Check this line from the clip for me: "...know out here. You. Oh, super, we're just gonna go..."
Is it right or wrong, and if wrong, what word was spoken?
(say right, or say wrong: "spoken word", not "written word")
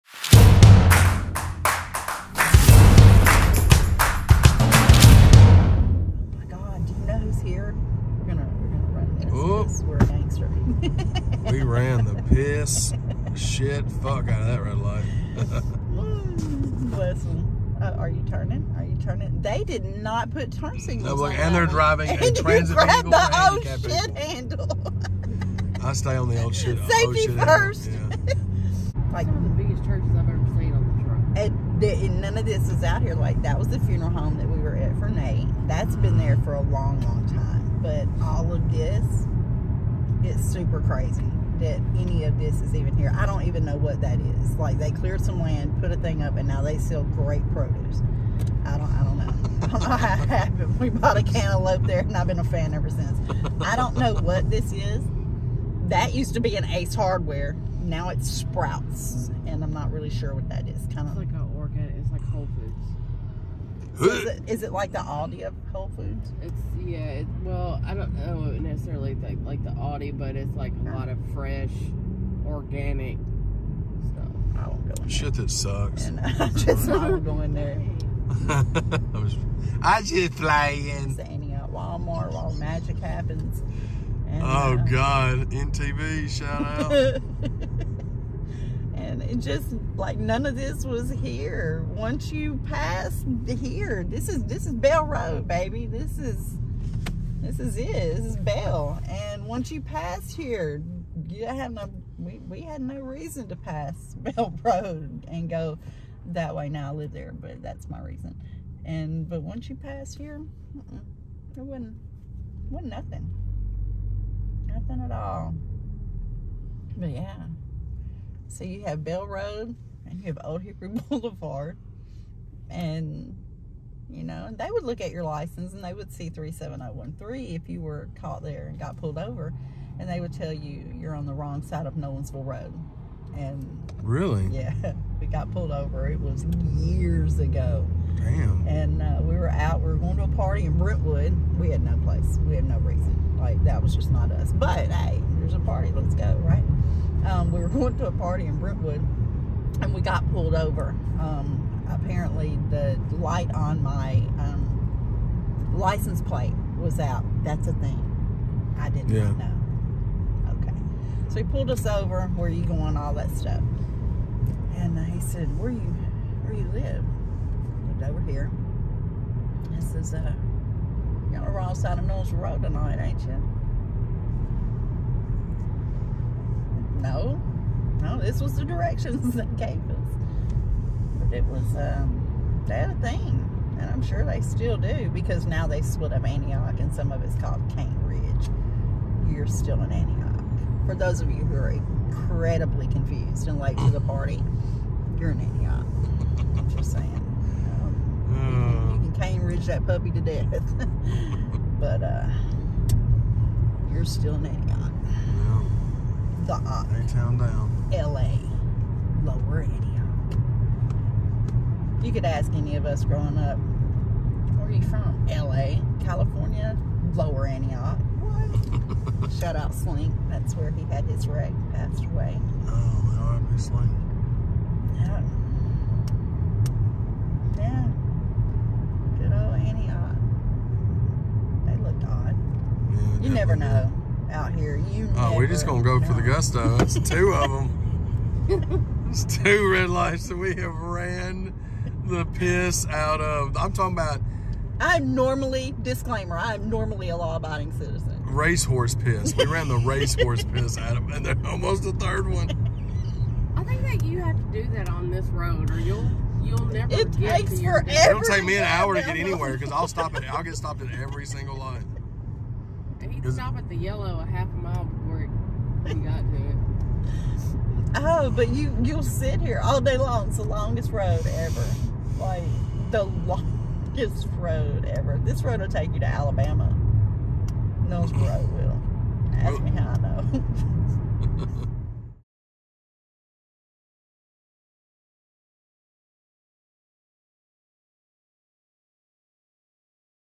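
wrong: "never", not "super".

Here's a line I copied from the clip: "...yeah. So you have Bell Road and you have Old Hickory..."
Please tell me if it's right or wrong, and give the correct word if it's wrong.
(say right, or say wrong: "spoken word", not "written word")
right.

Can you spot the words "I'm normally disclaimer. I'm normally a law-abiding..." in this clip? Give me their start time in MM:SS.
04:04.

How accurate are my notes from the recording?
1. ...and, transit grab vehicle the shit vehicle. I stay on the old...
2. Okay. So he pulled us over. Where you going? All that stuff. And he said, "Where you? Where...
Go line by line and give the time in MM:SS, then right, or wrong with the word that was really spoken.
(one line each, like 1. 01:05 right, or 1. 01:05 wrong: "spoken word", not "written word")
1. 00:22 wrong: "handle", not "vehicle"
2. 02:40 right.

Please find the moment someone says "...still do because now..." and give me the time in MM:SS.
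03:04.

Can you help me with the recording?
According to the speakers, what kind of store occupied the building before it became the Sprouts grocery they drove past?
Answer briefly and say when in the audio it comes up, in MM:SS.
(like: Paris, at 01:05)
Ace Hardware, at 00:56.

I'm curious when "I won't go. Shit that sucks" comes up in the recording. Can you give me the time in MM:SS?
01:14.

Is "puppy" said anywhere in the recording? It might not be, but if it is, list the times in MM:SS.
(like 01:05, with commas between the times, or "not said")
03:19.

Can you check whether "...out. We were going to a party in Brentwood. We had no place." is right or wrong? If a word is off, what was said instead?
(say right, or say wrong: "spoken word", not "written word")
right.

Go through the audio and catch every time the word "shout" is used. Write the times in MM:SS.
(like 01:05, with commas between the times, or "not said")
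01:26, 03:39.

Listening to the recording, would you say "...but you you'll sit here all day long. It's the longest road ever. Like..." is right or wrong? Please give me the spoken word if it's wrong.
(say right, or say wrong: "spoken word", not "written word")
right.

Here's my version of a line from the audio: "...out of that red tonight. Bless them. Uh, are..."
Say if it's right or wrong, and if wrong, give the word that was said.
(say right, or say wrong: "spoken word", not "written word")
wrong: "light", not "tonight".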